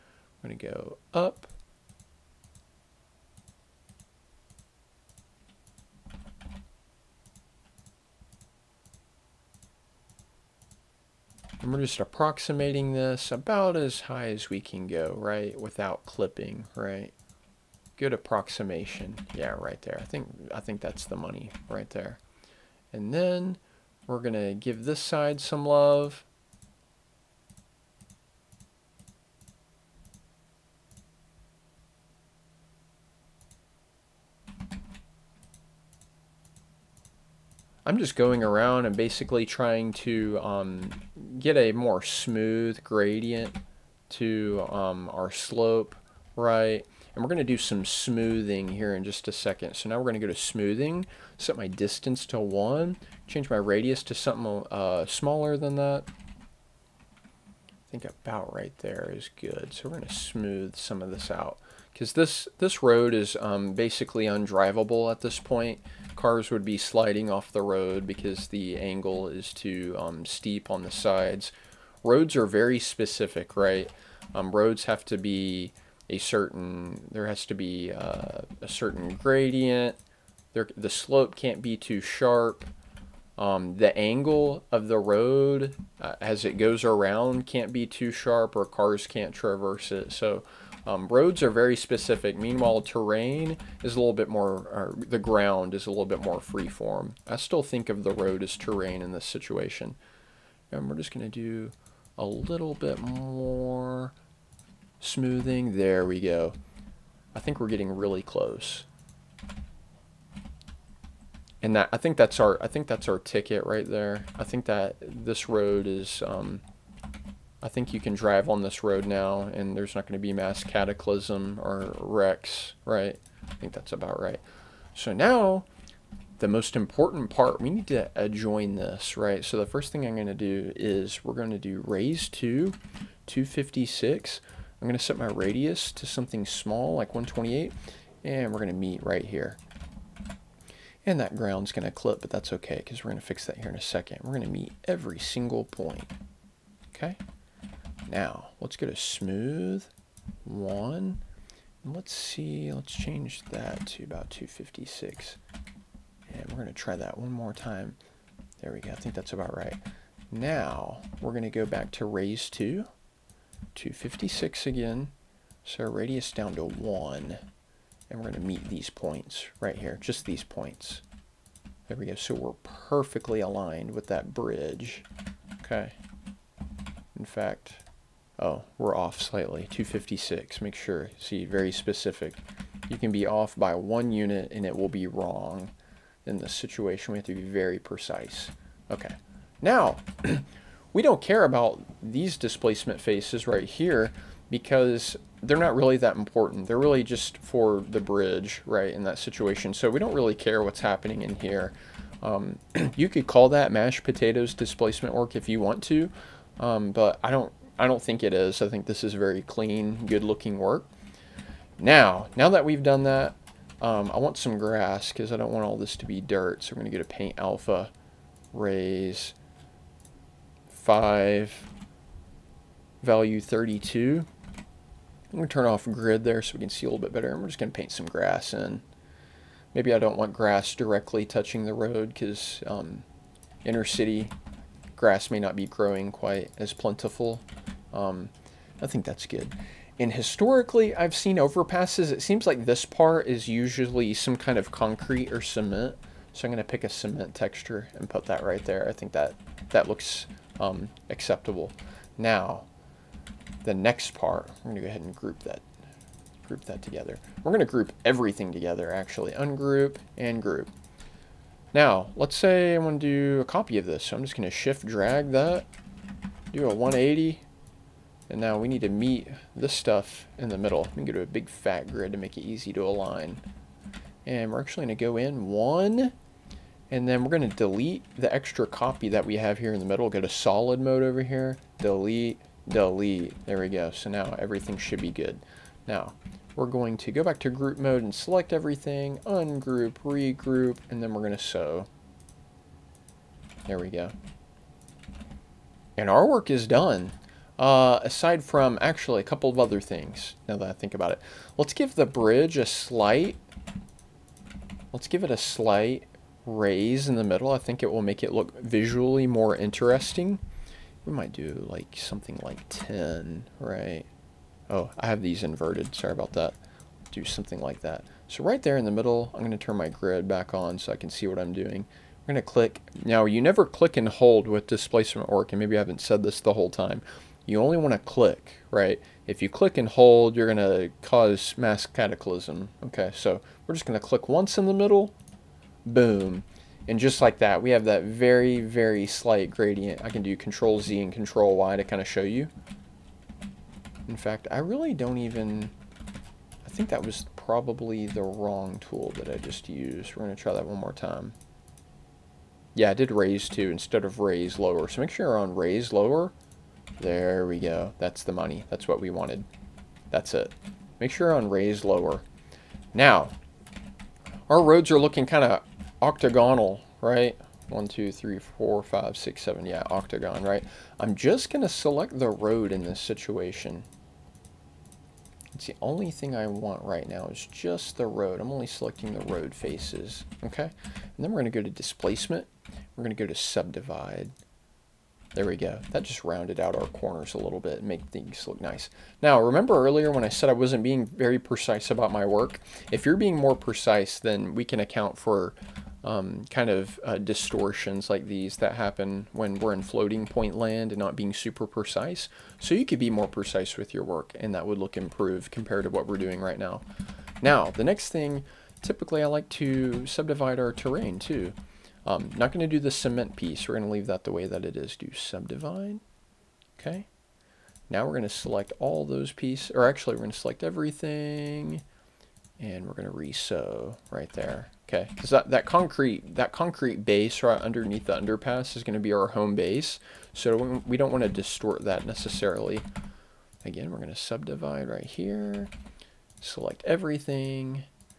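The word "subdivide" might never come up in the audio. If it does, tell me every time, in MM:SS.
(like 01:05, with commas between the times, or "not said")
06:23, 06:50, 06:55, 07:14.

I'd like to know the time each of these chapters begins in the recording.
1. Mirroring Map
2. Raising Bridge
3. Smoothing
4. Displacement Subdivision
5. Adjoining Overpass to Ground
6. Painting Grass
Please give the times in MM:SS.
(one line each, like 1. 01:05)
1. 04:16
2. 05:00
3. 00:48
4. 06:03
5. 02:05
6. 03:31.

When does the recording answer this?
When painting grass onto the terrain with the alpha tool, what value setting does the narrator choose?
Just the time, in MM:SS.
03:43.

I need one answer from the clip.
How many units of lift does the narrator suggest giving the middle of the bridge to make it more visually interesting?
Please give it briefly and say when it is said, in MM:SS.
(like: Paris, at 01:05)
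10, at 05:12.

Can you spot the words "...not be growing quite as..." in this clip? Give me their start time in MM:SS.
03:55.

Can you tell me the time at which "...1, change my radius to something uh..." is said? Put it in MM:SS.
00:52.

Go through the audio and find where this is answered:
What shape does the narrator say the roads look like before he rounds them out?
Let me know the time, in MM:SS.
06:06.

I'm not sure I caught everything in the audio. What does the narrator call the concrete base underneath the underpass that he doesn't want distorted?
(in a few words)
home base.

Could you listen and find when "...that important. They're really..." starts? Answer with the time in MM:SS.
03:15.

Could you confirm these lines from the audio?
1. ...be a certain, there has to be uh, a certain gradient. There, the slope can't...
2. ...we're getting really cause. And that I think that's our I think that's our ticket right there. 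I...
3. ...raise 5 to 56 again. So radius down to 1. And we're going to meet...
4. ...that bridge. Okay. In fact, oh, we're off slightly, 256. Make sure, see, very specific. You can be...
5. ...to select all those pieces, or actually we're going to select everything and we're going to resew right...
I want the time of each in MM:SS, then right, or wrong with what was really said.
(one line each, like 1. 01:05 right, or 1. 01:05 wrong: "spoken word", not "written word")
1. 01:15 right
2. 01:47 wrong: "close", not "cause"
3. 02:42 wrong: "2", not "5"
4. 02:54 right
5. 06:58 right.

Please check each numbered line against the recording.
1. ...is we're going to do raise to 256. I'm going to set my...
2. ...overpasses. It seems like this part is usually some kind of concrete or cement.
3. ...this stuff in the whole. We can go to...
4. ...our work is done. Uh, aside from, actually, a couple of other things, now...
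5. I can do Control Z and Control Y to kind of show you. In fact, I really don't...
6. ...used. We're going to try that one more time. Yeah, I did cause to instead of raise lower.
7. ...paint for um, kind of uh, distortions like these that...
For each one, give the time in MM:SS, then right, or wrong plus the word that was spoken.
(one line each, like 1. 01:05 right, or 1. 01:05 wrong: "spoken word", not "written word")
1. 02:10 right
2. 04:01 right
3. 04:29 wrong: "middle", not "whole"
4. 04:56 right
5. 05:40 right
6. 05:49 wrong: "raise", not "cause"
7. 06:34 wrong: "account", not "paint".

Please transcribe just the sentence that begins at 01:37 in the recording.
I still think of the road as terrain in this situation.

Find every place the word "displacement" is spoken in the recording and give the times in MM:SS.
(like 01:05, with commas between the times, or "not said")
03:12, 03:24, 05:24, 06:21.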